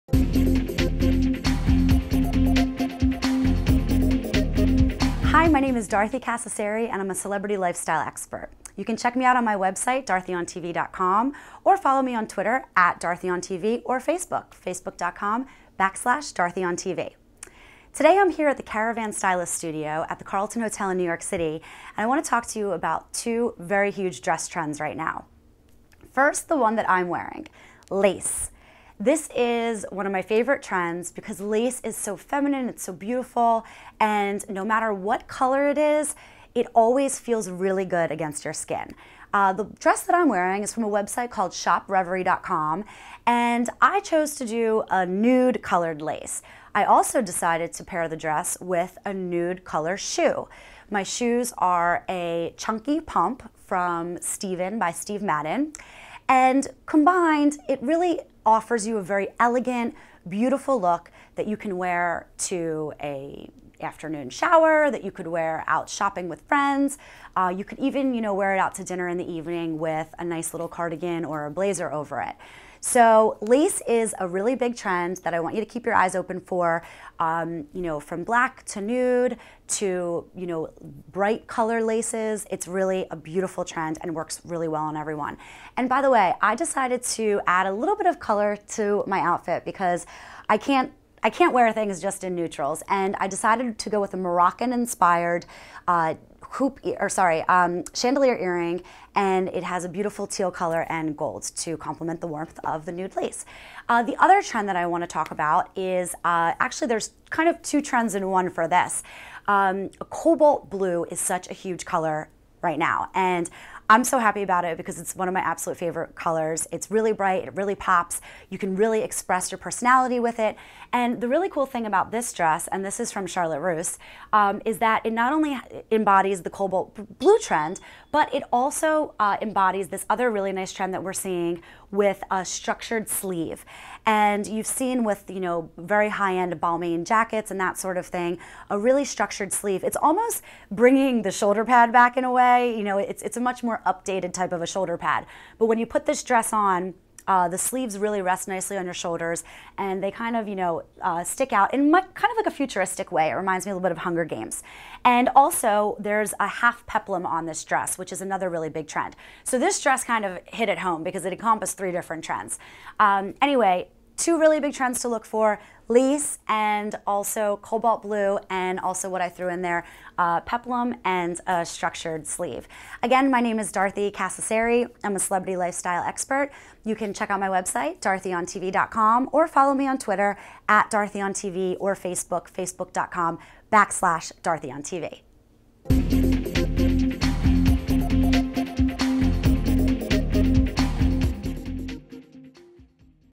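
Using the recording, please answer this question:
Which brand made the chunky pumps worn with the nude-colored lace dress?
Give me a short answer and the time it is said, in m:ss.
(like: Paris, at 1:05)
Steven by Steve Madden, at 0:54.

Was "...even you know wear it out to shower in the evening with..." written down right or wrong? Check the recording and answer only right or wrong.
wrong.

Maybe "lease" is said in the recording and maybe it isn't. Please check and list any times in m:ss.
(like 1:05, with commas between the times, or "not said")
2:45.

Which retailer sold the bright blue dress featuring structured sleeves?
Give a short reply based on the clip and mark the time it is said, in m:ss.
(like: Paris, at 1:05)
Charlotte Russe, at 2:03.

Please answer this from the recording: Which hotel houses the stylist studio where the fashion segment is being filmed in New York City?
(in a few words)
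Carlton Hotel.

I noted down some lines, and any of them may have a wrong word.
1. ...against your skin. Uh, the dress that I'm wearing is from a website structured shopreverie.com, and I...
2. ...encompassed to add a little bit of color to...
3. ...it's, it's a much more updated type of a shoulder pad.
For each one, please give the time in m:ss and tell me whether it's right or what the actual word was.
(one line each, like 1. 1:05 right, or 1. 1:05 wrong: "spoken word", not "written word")
1. 0:38 wrong: "called", not "structured"
2. 1:26 wrong: "decided", not "encompassed"
3. 2:22 right.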